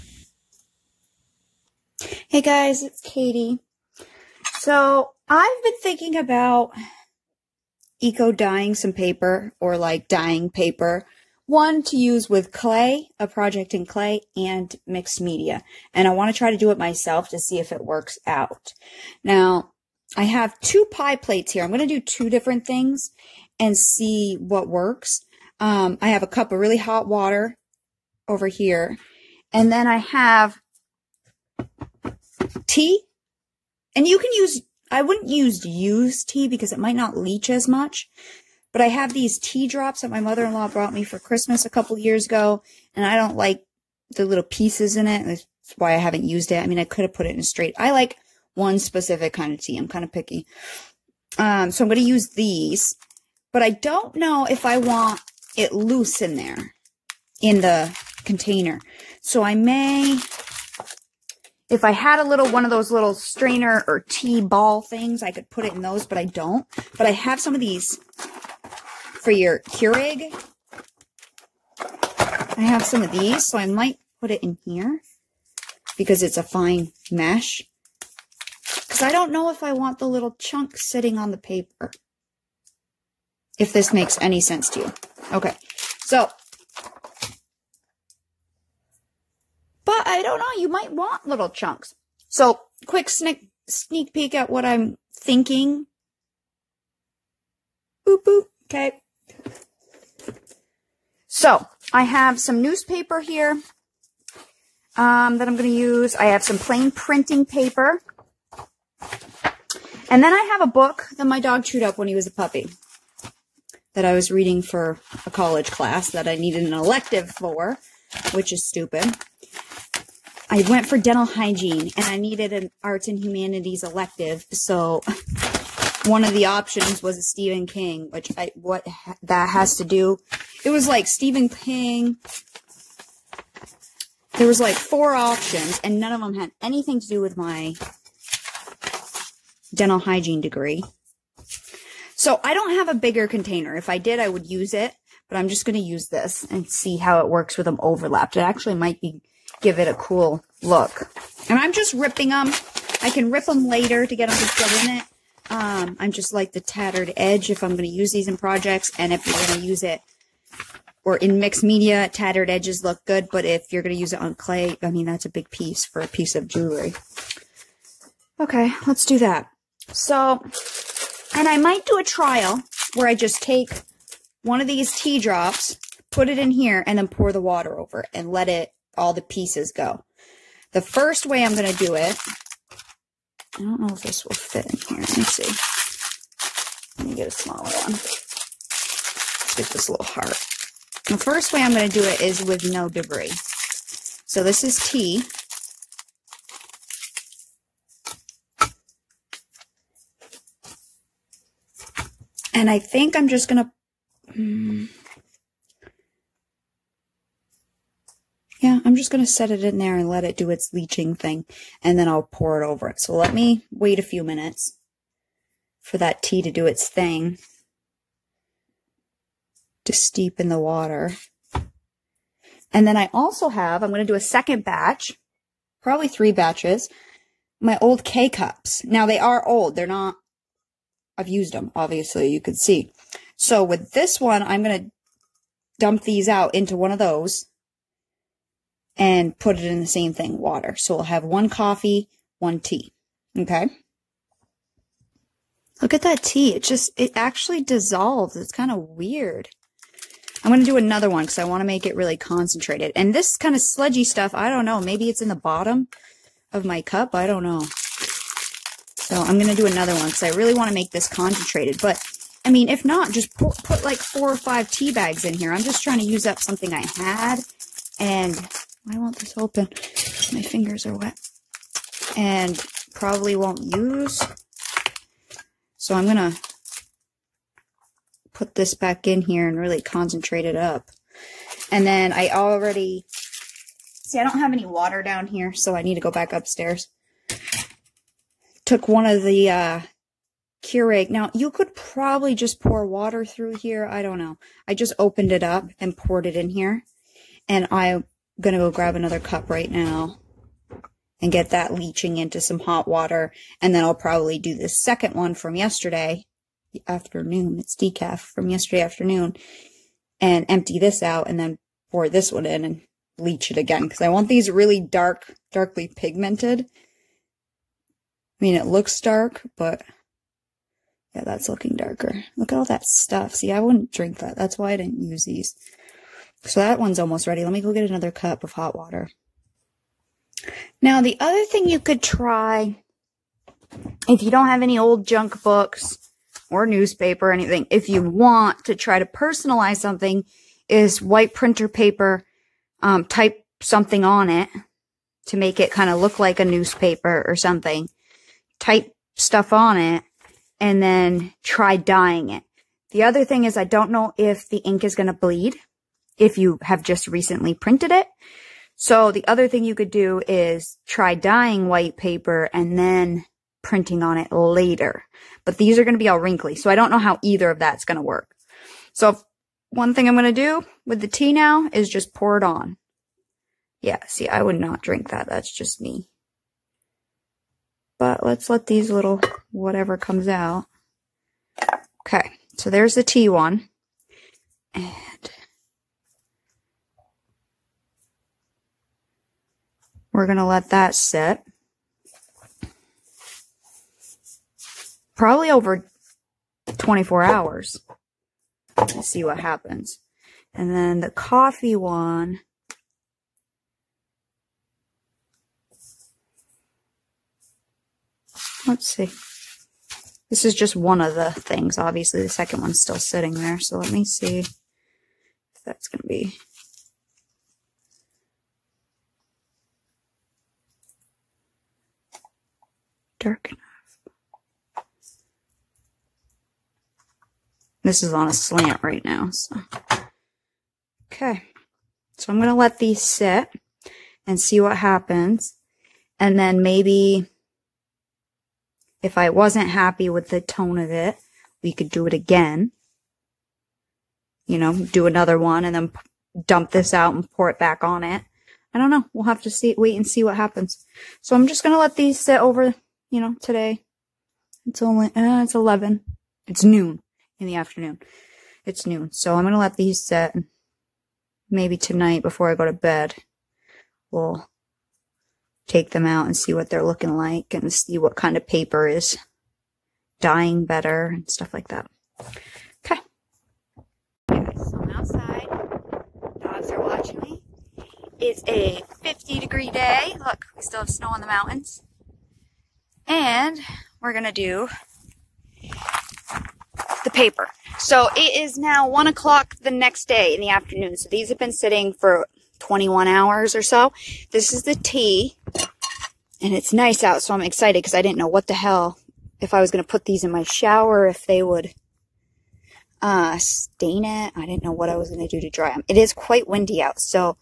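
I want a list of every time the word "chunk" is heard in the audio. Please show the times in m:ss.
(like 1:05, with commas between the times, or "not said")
1:20, 1:31.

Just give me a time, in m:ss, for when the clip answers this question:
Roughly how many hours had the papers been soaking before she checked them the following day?
8:12.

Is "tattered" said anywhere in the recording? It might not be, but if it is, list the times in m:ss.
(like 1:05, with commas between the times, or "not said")
2:36, 2:42.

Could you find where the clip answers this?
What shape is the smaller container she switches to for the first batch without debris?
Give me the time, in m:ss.
3:10.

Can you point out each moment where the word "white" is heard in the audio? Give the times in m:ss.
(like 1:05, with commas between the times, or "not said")
5:41, 6:01.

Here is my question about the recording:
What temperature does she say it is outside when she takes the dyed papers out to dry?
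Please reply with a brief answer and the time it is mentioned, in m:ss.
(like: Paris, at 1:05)
50 degrees, at 7:59.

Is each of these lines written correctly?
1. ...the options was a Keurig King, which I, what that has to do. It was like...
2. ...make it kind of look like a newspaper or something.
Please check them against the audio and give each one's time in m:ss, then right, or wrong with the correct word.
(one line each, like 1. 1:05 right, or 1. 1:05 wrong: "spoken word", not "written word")
1. 2:06 wrong: "Stephen", not "Keurig"
2. 5:45 right.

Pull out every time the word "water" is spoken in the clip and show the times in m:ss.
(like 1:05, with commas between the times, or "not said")
0:27, 2:57, 3:40, 4:00, 4:44, 4:52, 5:02, 5:28.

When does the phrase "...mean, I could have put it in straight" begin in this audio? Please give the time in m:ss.
0:46.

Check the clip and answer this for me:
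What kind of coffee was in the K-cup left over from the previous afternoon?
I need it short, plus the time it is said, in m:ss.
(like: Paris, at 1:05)
Decaf, at 5:07.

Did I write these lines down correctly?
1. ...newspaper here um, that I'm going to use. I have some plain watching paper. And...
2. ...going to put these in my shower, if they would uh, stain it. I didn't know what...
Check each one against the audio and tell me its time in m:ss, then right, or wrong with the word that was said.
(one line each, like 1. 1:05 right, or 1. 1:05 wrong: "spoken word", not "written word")
1. 1:42 wrong: "printing", not "watching"
2. 8:19 right.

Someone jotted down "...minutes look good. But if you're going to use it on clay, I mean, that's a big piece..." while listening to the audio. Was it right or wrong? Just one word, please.
wrong.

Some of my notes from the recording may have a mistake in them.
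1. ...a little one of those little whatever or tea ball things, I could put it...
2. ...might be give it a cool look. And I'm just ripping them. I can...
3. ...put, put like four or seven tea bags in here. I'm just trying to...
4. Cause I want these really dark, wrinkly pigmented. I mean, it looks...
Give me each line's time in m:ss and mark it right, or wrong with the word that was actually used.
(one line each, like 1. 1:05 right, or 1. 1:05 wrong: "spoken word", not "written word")
1. 1:02 wrong: "strainer", not "whatever"
2. 2:28 right
3. 4:23 wrong: "five", not "seven"
4. 5:13 wrong: "darkly", not "wrinkly".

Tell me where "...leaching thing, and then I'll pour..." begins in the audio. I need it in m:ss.
3:30.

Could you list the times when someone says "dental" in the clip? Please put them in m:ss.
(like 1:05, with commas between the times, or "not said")
2:00, 2:19.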